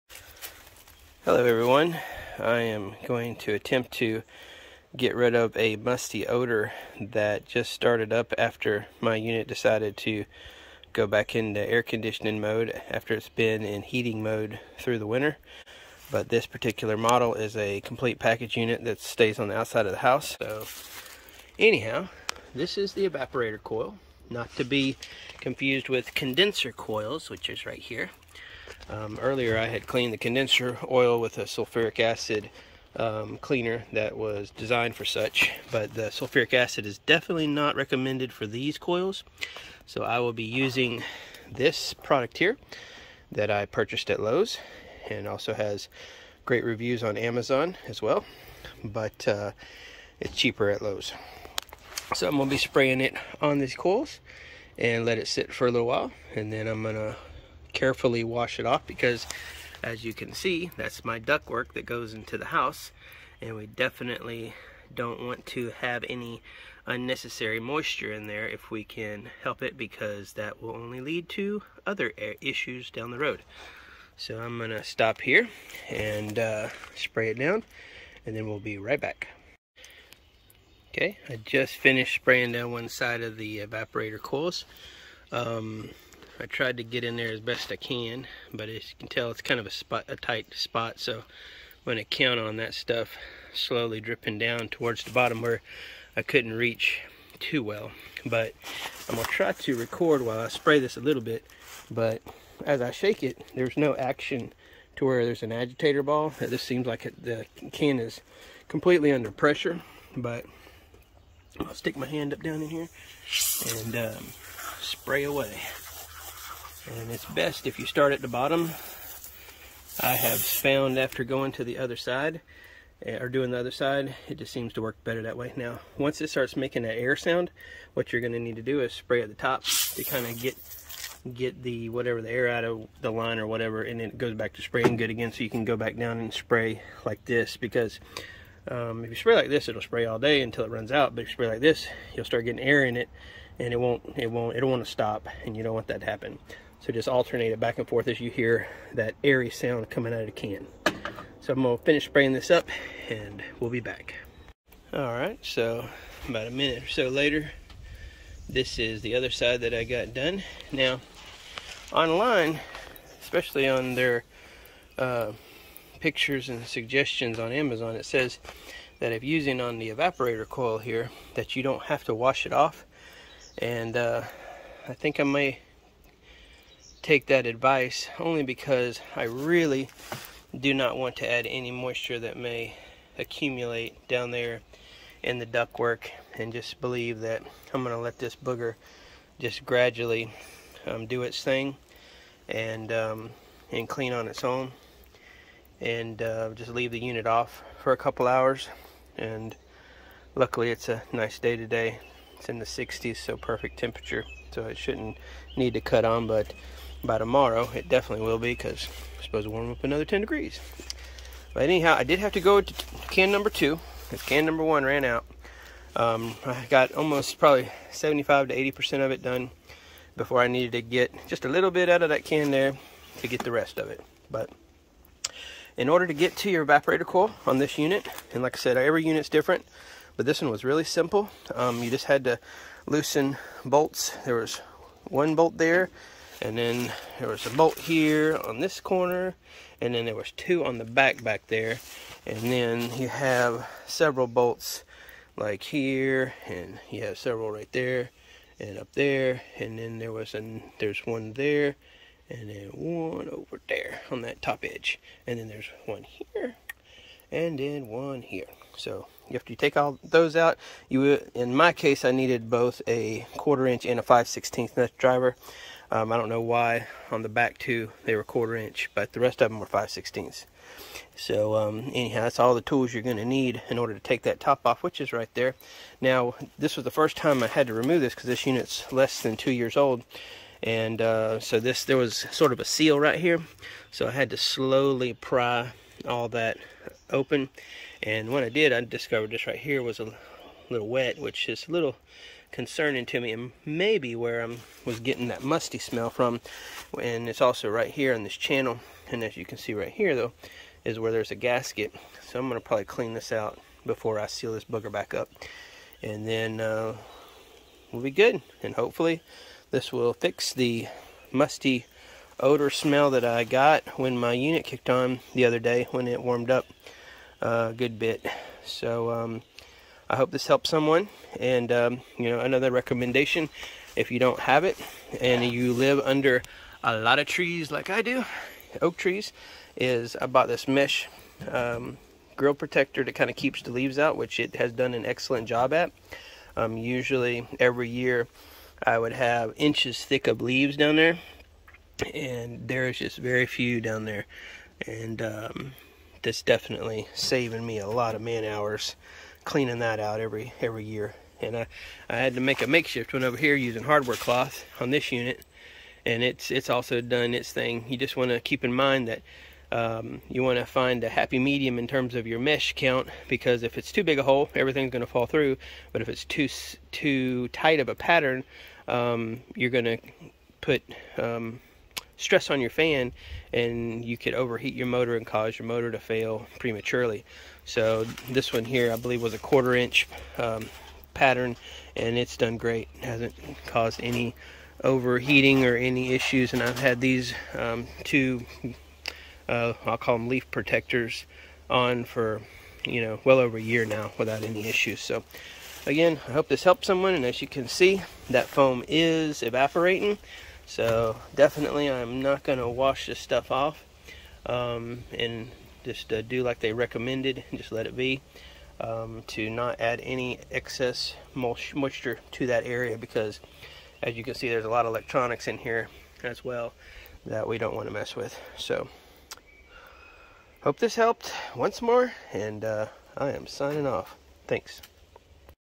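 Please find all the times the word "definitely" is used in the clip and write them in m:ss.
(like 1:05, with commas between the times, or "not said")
0:36, 1:03, 3:27, 5:46, 6:41.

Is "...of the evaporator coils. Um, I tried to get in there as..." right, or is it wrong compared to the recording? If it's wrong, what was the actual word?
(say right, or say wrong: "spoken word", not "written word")
right.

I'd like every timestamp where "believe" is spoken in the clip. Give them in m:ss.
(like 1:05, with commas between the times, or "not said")
3:06, 6:18.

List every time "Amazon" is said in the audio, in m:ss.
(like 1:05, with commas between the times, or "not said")
0:47, 2:47.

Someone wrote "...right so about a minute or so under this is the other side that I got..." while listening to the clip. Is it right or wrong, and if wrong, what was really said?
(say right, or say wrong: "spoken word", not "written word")
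wrong: "later", not "under".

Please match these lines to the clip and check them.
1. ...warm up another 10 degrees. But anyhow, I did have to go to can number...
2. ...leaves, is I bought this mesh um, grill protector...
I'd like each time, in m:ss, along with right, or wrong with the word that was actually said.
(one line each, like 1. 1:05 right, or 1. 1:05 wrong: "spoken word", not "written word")
1. 3:29 right
2. 5:28 wrong: "trees", not "leaves".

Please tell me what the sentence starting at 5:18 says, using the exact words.
So um, I hope this helps someone.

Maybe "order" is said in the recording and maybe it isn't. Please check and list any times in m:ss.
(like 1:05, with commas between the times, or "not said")
3:45, 4:33.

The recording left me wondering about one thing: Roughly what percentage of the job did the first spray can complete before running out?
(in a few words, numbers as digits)
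75 to 80%.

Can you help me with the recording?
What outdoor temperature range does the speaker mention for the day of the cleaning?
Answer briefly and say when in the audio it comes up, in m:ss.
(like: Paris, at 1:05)
the 60s, at 3:22.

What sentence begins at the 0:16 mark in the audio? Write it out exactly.
But this particular model is a complete package unit that stays on the outside of the house.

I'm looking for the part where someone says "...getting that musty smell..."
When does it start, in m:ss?
4:54.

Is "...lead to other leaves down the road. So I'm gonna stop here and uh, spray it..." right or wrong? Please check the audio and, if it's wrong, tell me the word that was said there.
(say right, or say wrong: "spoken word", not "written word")
wrong: "issues", not "leaves".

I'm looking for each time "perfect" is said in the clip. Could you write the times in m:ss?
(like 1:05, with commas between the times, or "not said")
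3:23.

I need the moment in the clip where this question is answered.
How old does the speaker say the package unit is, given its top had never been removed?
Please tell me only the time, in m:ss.
4:38.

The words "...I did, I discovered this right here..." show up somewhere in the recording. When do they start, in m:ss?
4:48.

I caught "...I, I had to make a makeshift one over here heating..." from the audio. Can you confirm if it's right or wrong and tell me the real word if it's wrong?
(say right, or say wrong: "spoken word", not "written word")
wrong: "using", not "heating".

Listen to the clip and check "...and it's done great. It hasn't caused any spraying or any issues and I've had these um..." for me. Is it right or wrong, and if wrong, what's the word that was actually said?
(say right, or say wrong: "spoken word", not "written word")
wrong: "overheating", not "spraying".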